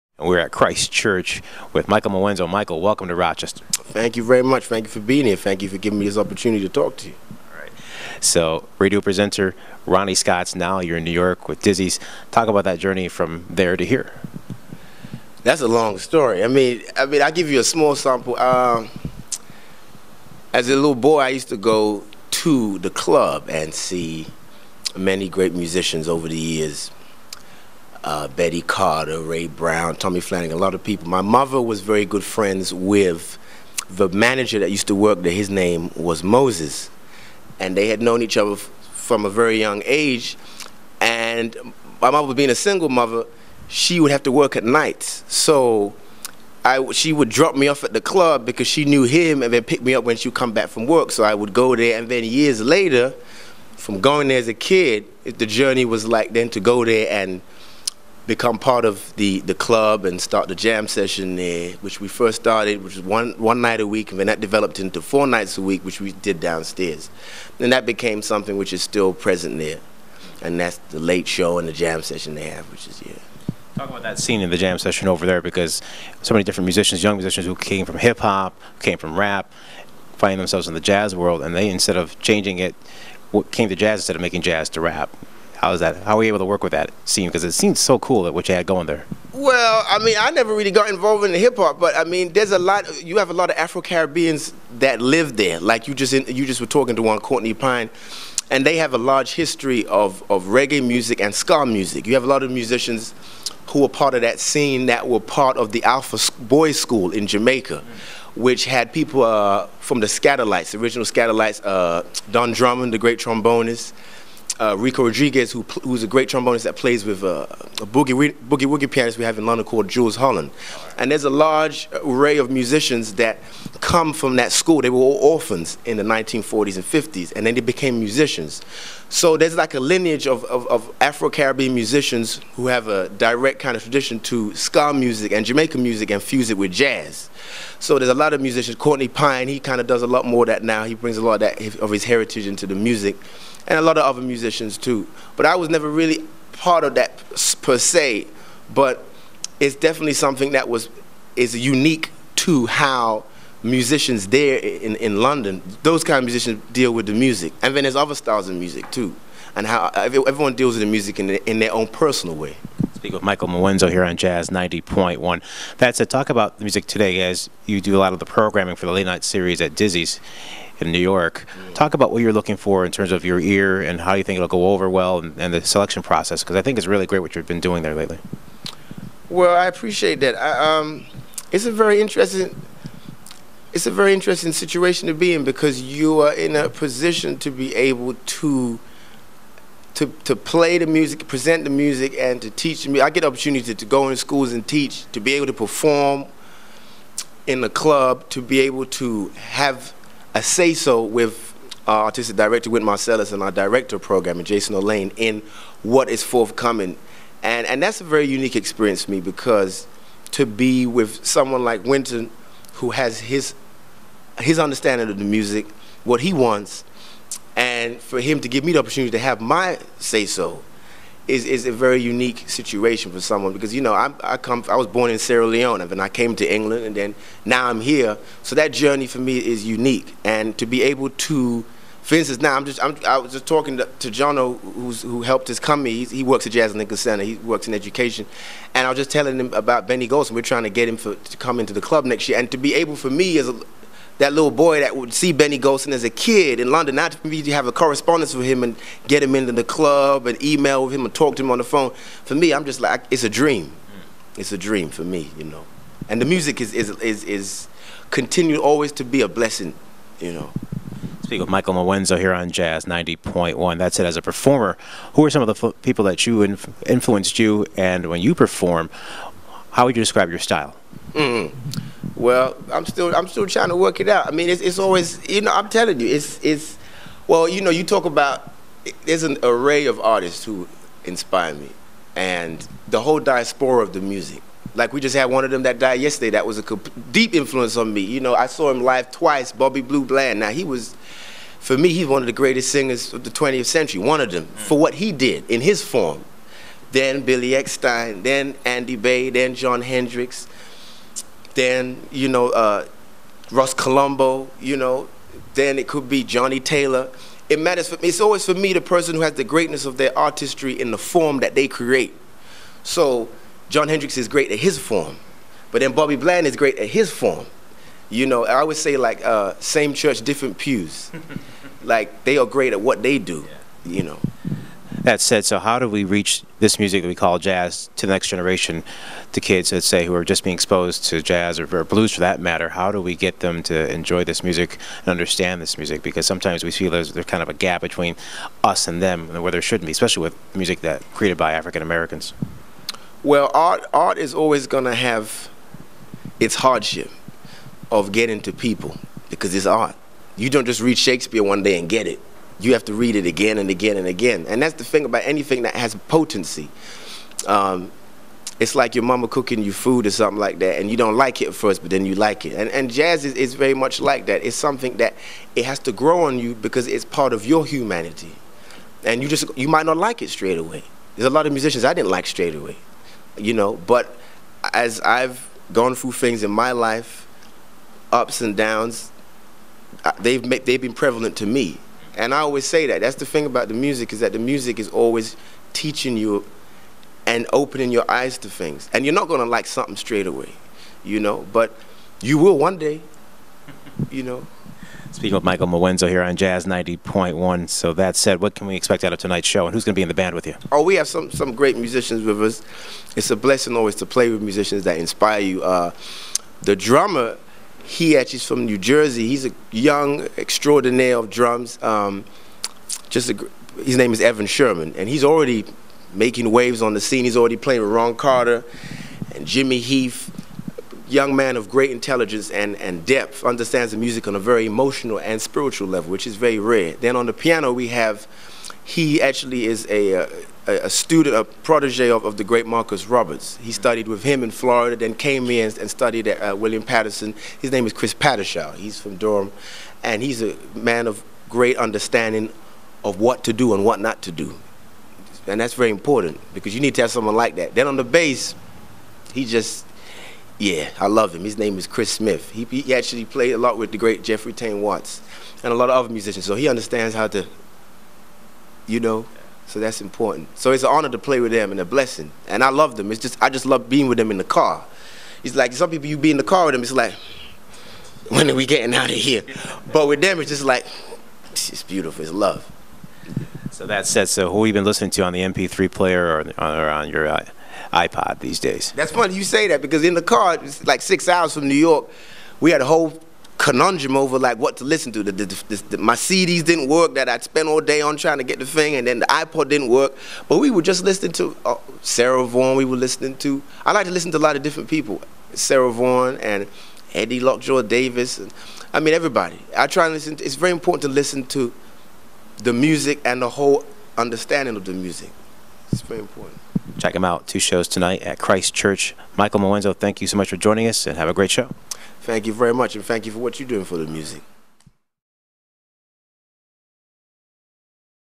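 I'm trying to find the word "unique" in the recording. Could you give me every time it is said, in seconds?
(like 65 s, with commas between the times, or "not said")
151 s, 208 s, 222 s, 229 s.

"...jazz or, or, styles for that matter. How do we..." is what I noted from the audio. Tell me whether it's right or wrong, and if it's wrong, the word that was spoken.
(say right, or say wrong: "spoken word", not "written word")
wrong: "blues", not "styles".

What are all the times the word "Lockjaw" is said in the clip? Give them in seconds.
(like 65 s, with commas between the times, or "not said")
497 s.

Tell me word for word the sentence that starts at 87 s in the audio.
Because it seems so cool that what you had going there.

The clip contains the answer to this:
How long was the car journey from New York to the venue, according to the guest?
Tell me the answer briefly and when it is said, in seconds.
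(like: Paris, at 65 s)
6 hours, at 481 s.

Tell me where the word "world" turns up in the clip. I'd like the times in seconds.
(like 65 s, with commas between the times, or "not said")
81 s.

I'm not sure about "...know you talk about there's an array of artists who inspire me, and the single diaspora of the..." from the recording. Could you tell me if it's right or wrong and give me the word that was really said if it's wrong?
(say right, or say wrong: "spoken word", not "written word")
wrong: "whole", not "single".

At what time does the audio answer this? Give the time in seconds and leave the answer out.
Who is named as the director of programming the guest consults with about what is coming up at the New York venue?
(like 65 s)
204 s.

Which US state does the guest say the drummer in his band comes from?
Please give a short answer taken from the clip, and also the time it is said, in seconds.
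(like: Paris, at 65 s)
New Jersey, at 408 s.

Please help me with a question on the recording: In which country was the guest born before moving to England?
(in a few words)
Sierra Leone.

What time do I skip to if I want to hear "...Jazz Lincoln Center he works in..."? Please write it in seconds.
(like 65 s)
236 s.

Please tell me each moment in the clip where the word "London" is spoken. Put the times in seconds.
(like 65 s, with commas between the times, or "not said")
119 s, 155 s, 246 s.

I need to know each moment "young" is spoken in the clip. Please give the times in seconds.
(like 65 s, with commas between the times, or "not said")
39 s, 77 s, 409 s, 421 s.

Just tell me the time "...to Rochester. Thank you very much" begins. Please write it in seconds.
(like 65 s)
3 s.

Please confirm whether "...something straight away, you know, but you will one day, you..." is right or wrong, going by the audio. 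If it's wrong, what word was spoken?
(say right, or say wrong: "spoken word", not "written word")
right.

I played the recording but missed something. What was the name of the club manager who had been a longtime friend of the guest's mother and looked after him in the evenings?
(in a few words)
Moses.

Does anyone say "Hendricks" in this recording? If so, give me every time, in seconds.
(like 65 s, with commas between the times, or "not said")
299 s, 313 s.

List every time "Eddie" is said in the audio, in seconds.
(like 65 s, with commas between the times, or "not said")
497 s.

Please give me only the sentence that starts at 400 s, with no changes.
Oh, we have some, some great musicians with us.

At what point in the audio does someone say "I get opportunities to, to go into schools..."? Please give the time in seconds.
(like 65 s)
193 s.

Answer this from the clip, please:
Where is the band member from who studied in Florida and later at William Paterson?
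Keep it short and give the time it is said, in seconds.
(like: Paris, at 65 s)
Durham, at 439 s.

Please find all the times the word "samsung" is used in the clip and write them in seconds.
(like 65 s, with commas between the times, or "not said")
not said.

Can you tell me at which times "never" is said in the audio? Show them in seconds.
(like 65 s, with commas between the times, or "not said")
90 s, 145 s.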